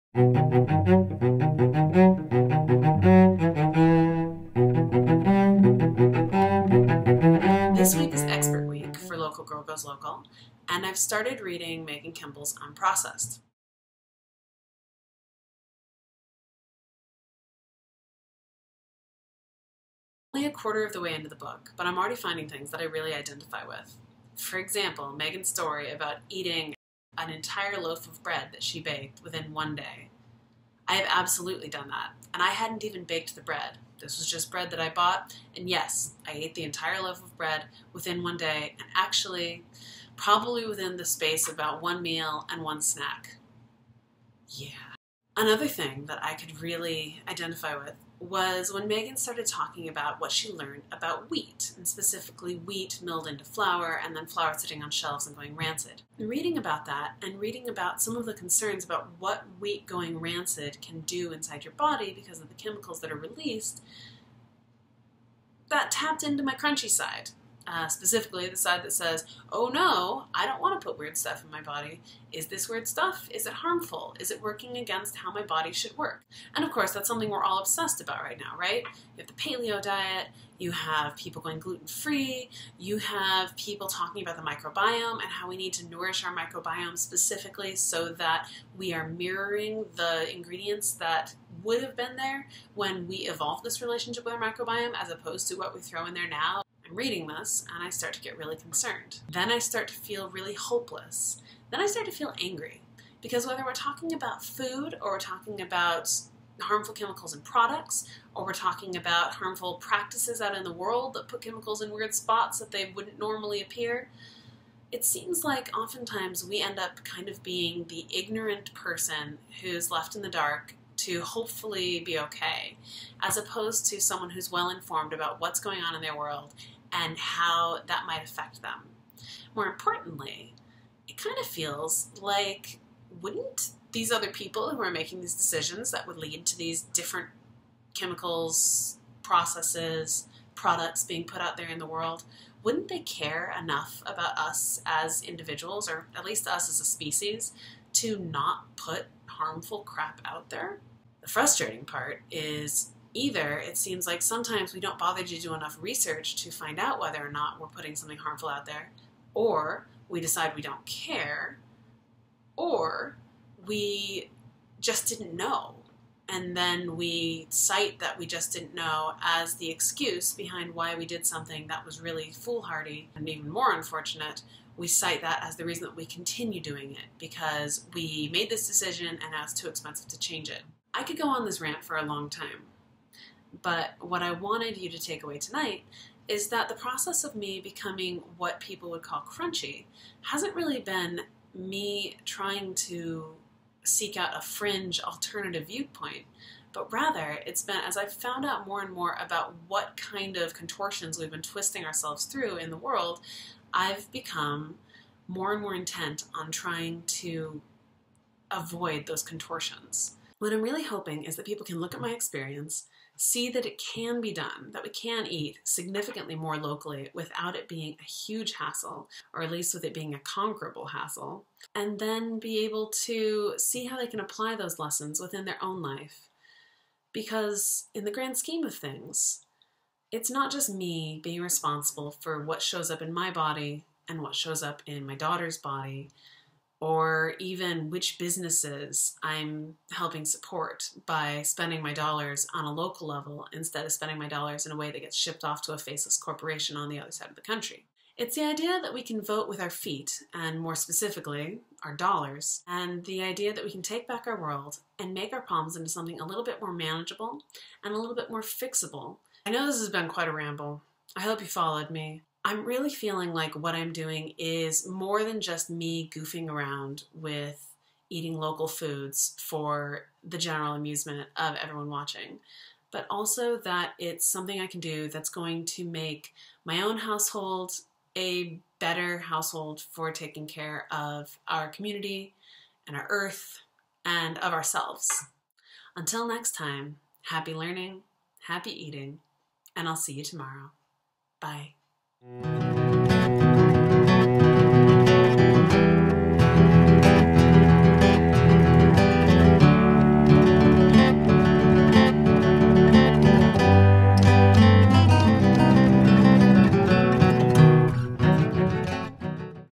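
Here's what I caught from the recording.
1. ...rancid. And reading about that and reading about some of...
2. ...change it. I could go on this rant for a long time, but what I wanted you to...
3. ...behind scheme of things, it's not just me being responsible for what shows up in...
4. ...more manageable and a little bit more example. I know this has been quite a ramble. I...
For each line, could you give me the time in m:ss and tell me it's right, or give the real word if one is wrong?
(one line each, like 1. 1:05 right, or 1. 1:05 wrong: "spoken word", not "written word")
1. 0:55 right
2. 3:00 right
3. 3:48 wrong: "grand", not "behind"
4. 4:16 wrong: "fixable", not "example".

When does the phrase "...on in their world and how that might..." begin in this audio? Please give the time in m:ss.
2:05.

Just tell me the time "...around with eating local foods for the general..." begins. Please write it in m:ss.
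4:26.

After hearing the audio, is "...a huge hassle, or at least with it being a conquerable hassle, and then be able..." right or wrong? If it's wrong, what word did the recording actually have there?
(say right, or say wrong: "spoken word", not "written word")
right.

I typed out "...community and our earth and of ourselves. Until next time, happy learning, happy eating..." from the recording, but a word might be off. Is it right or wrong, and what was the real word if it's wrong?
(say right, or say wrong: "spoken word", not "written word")
right.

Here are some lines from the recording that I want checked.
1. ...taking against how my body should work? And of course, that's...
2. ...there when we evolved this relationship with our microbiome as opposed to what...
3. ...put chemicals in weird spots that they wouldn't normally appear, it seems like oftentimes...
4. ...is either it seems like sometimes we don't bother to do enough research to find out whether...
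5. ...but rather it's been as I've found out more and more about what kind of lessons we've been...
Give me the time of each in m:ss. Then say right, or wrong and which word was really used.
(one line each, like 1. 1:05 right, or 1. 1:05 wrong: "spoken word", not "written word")
1. 1:14 wrong: "working", not "taking"
2. 1:32 right
3. 1:51 right
4. 2:32 right
5. 3:16 wrong: "contortions", not "lessons".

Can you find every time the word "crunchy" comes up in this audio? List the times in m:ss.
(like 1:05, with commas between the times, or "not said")
1:06, 3:09.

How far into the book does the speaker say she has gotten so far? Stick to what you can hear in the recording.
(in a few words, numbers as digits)
a quarter.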